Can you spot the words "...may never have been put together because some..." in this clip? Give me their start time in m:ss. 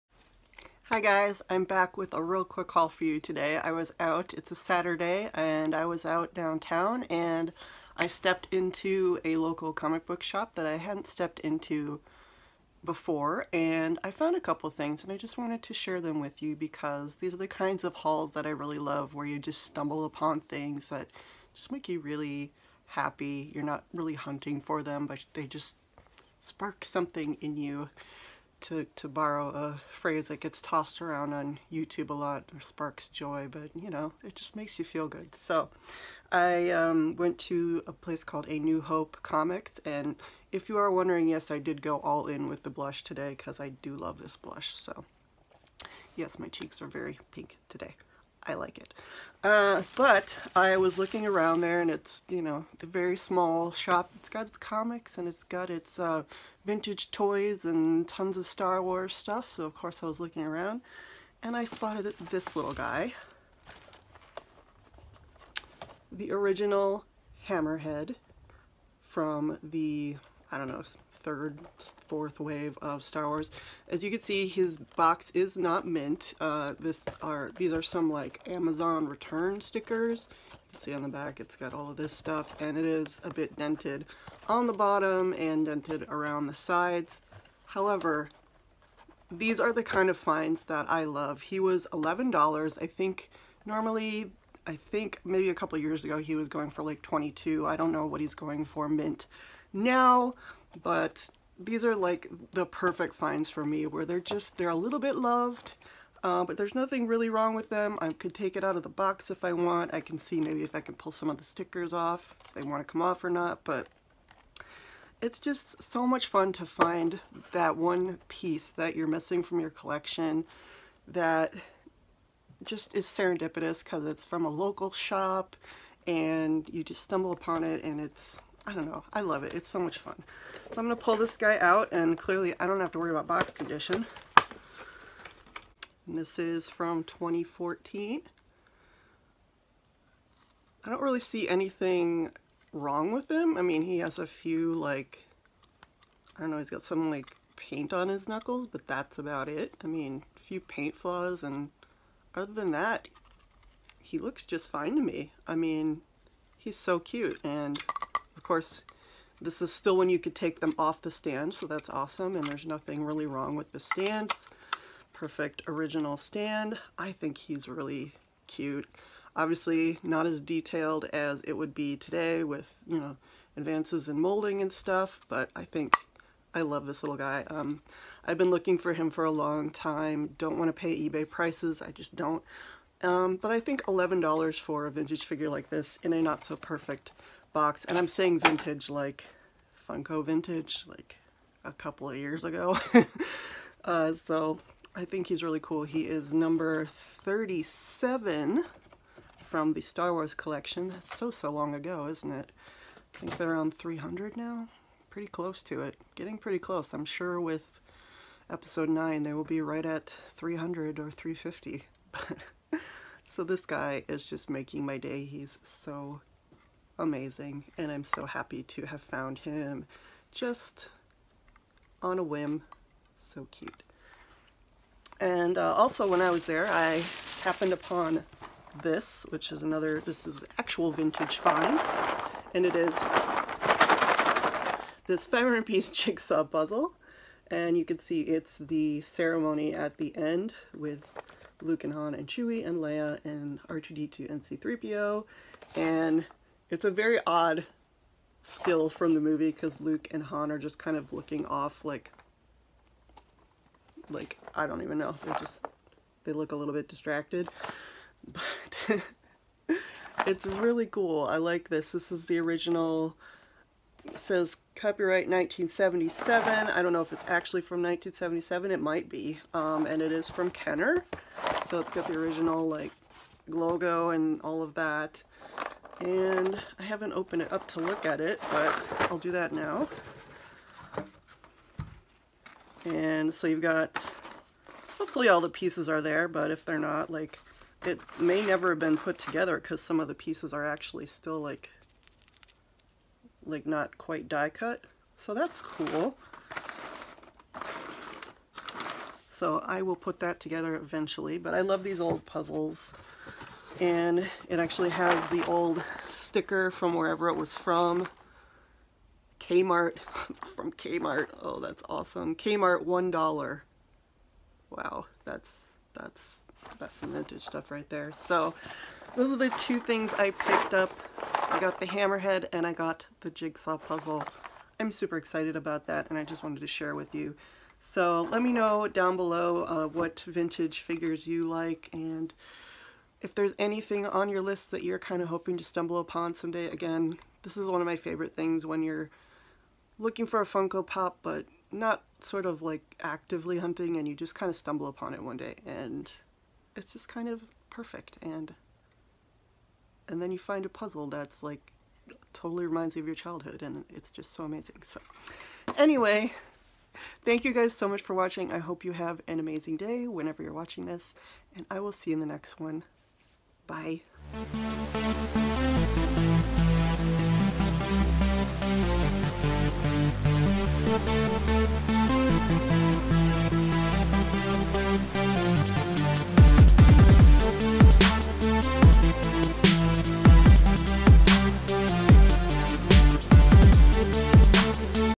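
4:48.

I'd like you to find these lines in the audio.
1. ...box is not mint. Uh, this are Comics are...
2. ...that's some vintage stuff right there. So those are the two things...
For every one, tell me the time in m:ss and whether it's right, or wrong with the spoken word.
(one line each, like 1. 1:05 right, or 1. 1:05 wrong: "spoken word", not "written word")
1. 1:14 wrong: "These", not "Comics"
2. 5:16 right.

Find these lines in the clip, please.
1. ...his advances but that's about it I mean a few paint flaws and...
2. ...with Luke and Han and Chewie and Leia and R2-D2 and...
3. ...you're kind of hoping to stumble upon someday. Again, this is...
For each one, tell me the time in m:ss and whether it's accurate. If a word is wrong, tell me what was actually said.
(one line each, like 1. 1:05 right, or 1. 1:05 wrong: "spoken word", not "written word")
1. 2:28 wrong: "knuckles", not "advances"
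2. 4:00 right
3. 5:34 right.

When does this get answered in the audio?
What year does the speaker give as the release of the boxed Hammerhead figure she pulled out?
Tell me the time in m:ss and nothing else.
2:17.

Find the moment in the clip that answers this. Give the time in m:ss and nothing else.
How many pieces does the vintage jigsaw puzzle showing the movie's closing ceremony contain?
3:55.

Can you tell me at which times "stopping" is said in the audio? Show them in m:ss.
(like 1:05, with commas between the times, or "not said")
not said.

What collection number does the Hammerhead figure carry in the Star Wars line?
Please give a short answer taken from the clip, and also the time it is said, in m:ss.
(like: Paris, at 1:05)
37, at 3:16.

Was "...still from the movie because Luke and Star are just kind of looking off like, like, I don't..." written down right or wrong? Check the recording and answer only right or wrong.
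wrong.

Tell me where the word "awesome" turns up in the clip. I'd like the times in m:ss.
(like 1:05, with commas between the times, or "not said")
2:41, 5:11.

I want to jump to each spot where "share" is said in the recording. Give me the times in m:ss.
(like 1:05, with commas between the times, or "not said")
0:15, 5:26.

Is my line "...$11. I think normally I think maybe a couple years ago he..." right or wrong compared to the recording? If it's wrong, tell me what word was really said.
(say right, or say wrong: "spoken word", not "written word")
right.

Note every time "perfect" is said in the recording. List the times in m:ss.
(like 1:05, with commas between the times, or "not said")
1:42, 2:45, 3:06, 5:47.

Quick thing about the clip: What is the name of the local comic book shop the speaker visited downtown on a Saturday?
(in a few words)
A New Hope Comics.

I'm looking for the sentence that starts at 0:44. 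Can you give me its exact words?
So yes, my cheeks are very pink today.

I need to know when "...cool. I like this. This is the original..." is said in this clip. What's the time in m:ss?
4:20.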